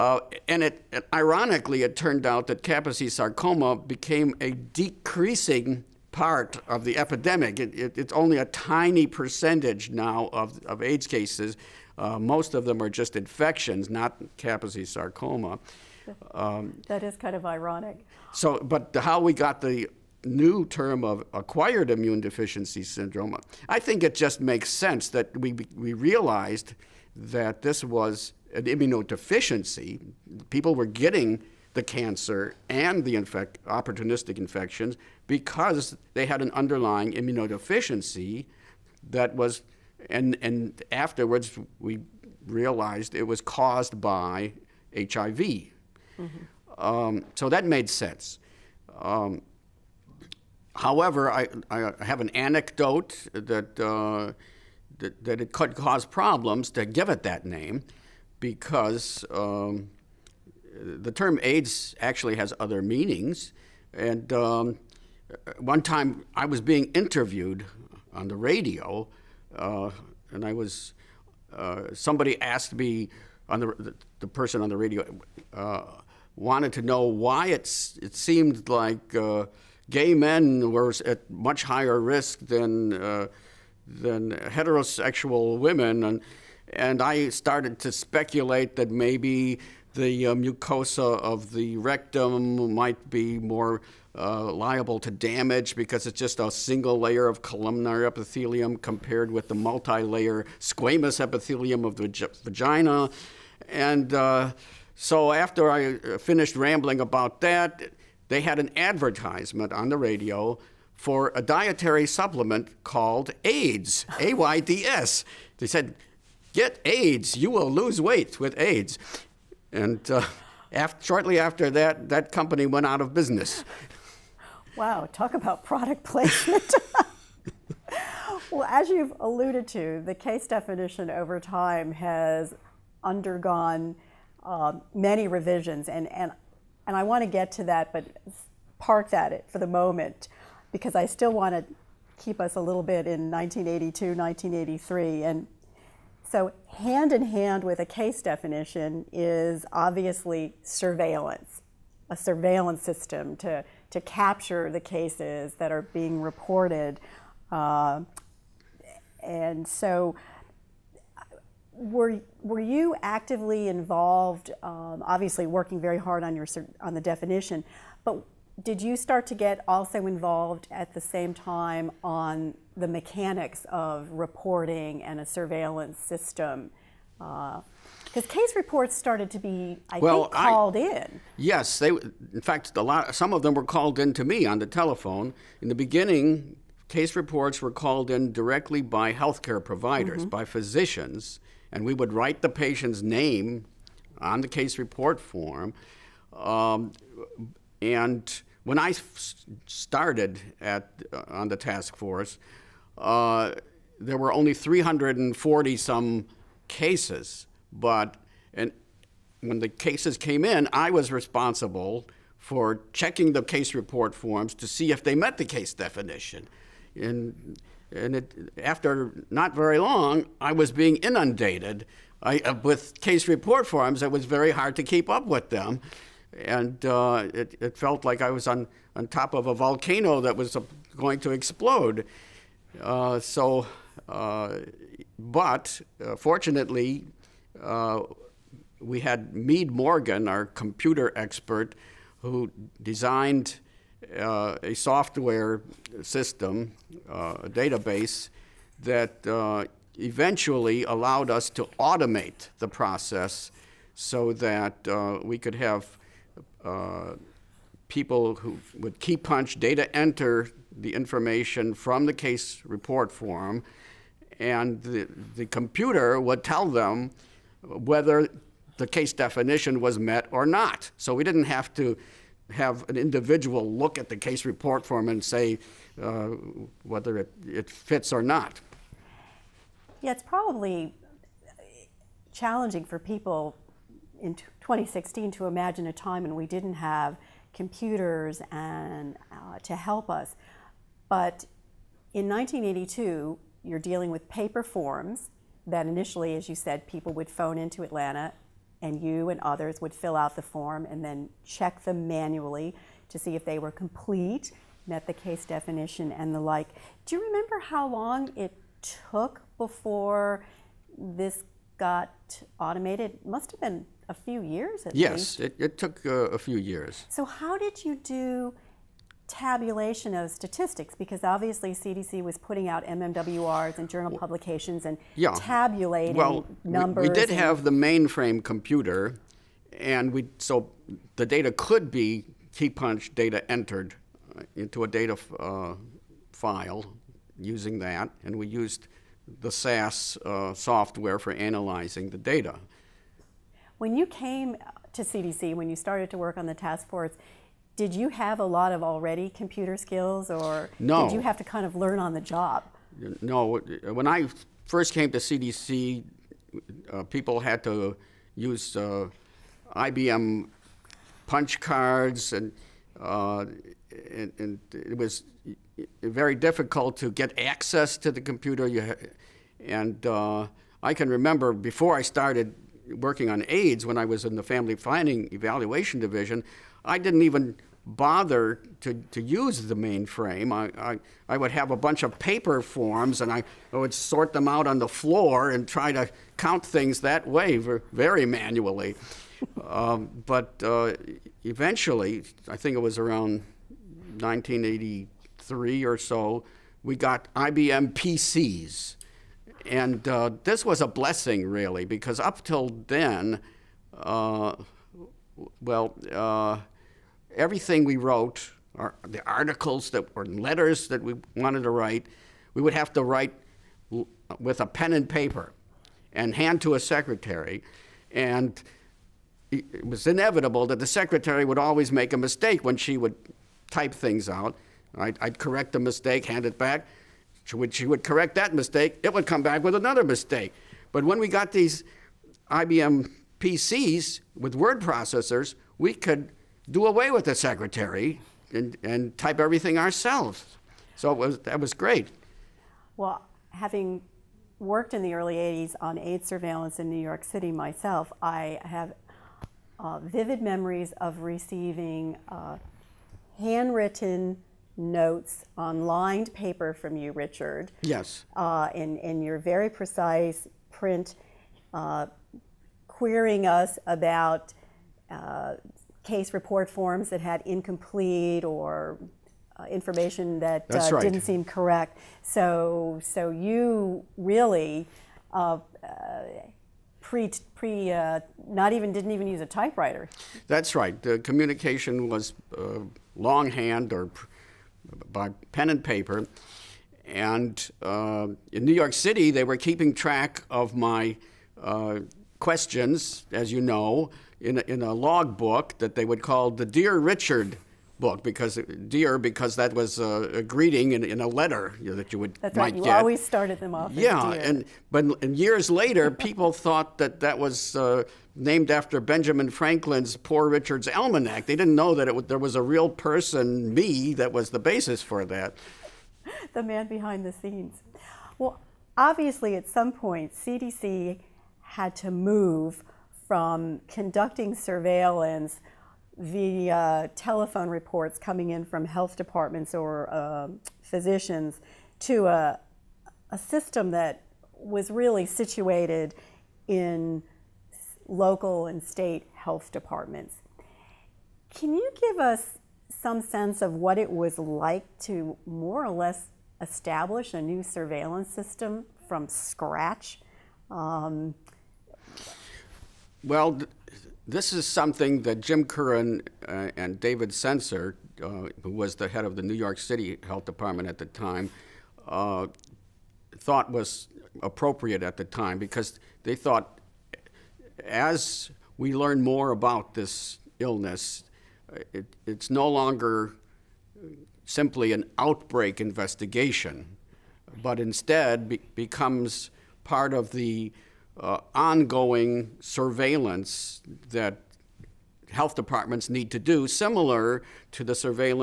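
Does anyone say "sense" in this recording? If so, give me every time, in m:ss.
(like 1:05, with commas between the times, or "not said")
0:24, 0:47, 9:03.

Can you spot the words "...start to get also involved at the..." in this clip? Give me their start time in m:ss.
2:48.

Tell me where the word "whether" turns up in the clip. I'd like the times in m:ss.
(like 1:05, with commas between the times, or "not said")
4:27, 4:36.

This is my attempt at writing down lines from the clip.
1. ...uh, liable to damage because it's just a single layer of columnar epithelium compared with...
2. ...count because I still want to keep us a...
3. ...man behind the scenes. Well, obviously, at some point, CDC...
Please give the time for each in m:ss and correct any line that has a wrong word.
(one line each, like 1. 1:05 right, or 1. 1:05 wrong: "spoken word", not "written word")
1. 1:34 right
2. 2:19 wrong: "moment", not "count"
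3. 8:36 right.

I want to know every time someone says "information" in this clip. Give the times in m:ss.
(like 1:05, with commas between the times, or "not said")
4:20, 7:49.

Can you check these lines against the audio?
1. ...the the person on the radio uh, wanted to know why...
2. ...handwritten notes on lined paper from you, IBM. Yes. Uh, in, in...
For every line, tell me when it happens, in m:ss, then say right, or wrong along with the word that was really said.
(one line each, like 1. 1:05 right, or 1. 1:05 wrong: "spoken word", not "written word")
1. 1:13 right
2. 7:33 wrong: "Richard", not "IBM".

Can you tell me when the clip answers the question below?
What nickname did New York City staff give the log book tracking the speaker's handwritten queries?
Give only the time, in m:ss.
8:16.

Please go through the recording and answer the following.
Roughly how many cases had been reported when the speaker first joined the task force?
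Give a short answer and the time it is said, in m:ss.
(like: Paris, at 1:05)
340, at 3:24.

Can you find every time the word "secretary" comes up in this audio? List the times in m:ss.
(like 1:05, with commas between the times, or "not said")
6:56, 7:00, 7:17.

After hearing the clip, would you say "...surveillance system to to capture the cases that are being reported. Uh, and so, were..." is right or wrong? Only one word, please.
right.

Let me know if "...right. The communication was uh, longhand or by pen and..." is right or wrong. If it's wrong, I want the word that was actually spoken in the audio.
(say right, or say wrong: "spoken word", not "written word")
right.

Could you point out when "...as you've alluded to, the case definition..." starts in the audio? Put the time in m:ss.
2:08.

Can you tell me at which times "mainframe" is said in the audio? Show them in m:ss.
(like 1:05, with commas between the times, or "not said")
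5:27, 6:19.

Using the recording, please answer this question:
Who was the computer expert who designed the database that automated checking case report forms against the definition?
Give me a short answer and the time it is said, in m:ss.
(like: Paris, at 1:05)
Meade Morgan, at 3:59.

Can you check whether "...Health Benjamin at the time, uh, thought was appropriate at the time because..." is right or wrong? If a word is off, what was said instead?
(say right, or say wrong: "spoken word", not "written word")
wrong: "Department", not "Benjamin".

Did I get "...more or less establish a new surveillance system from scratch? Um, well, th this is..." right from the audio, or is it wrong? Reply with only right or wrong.
right.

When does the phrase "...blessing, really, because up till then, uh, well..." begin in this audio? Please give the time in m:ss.
6:40.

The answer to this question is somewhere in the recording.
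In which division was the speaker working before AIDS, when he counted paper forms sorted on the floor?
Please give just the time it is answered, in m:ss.
6:14.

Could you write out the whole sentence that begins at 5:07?
Do you remember how long it took before this got automated?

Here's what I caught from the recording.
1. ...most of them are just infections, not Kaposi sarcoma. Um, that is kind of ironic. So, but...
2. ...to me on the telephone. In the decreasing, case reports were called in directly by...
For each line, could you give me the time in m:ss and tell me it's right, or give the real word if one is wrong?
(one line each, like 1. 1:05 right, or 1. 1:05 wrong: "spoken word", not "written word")
1. 0:12 right
2. 3:04 wrong: "beginning", not "decreasing".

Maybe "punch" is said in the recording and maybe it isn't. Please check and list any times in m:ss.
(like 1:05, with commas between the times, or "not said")
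4:19, 5:32, 6:01.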